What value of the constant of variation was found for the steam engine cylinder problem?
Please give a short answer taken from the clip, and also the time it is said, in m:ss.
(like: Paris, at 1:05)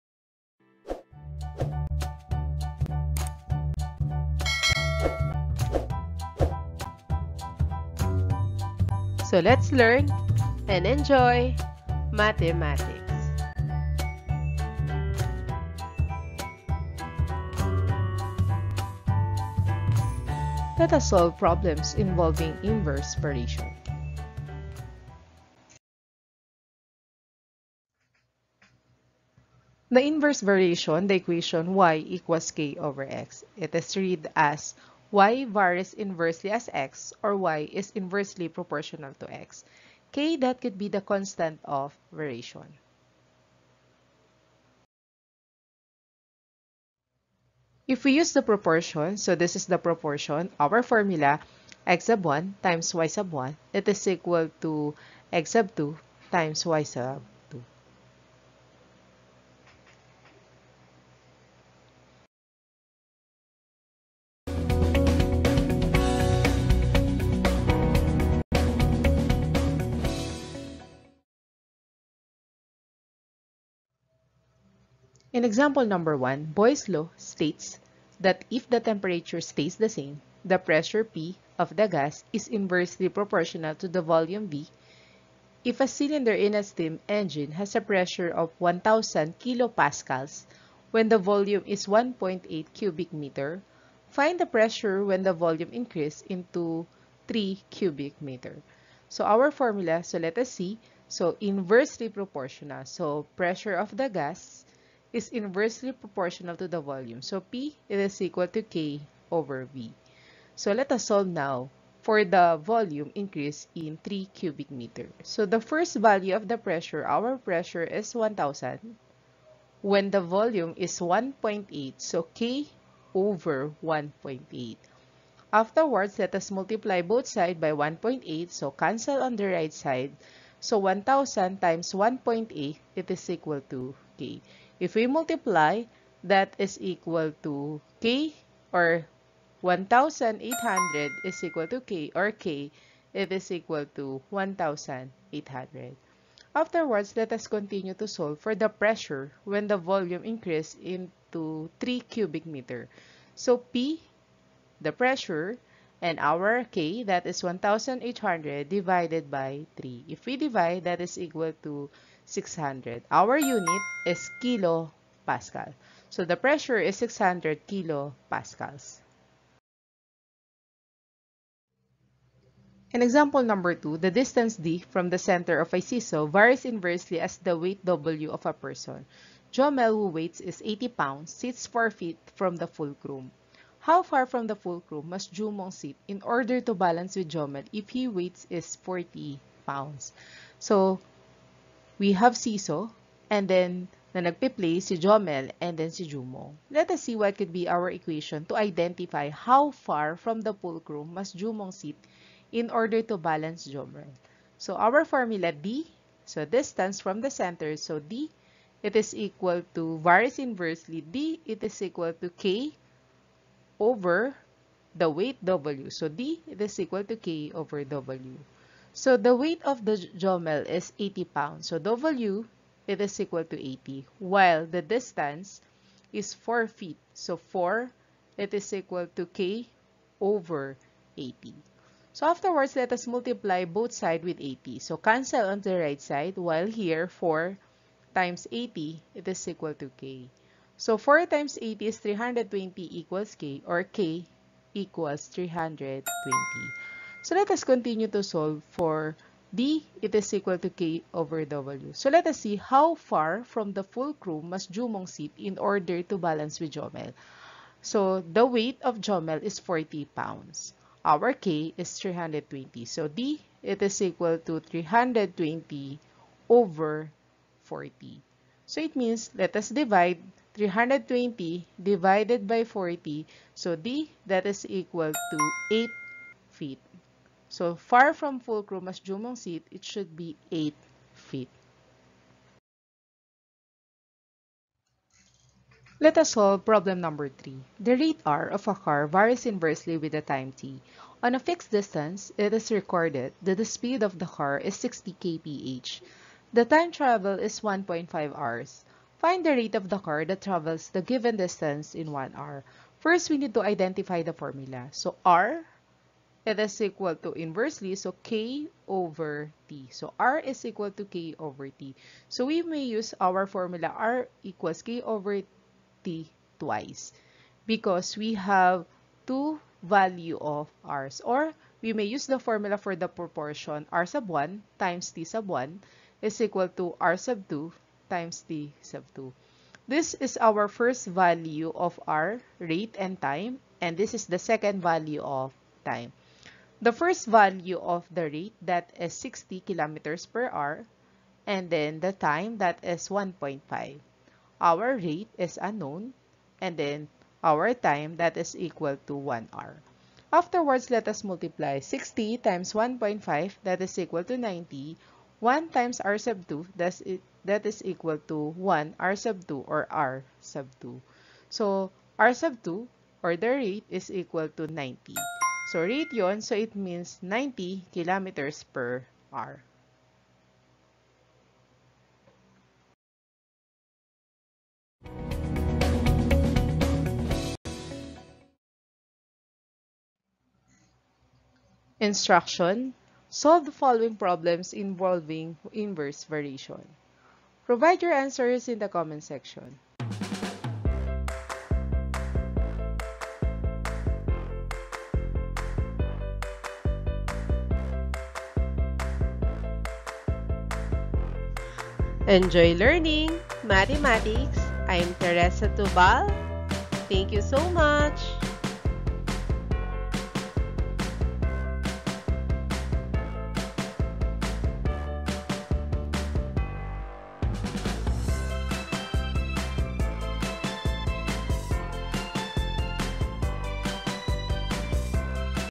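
1,800, at 2:19.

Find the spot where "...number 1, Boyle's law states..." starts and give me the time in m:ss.
1:15.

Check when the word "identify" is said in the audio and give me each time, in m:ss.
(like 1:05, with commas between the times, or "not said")
3:18, 5:03.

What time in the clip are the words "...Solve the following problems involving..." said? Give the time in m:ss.
6:23.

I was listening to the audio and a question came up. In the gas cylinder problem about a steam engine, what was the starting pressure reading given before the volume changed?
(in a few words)
1,000 kilopascals.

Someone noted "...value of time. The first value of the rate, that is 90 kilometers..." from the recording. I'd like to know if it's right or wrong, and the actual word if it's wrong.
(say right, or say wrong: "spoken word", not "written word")
wrong: "60", not "90".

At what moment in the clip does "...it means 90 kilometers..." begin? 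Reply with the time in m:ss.
6:06.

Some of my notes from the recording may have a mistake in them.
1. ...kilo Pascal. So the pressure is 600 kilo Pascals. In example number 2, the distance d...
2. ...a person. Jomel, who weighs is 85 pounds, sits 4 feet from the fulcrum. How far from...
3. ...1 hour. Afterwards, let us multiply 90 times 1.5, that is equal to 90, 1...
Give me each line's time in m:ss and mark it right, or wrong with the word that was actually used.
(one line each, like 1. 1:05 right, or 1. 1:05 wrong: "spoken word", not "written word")
1. 2:44 right
2. 2:58 wrong: "80", not "85"
3. 5:49 wrong: "60", not "90".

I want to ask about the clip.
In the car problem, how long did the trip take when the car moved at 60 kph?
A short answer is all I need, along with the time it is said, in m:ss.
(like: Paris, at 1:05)
1.5 hours, at 4:57.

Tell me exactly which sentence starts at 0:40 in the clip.
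K that could be the constant of variation.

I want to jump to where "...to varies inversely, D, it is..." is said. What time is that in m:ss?
3:29.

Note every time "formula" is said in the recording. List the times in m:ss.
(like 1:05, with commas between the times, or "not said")
0:50, 1:39, 3:25, 5:04, 5:13, 5:22.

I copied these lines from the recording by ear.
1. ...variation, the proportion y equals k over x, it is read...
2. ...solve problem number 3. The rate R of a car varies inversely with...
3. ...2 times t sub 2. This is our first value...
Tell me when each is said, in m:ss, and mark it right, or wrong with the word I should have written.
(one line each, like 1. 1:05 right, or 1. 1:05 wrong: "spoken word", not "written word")
1. 0:30 wrong: "equation", not "proportion"
2. 4:46 right
3. 5:27 right.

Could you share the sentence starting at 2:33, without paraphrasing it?
So P, the pressure, And our k, that is 1,800 divided by 3.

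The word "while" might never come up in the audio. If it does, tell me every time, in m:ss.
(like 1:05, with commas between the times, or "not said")
3:44, 3:56.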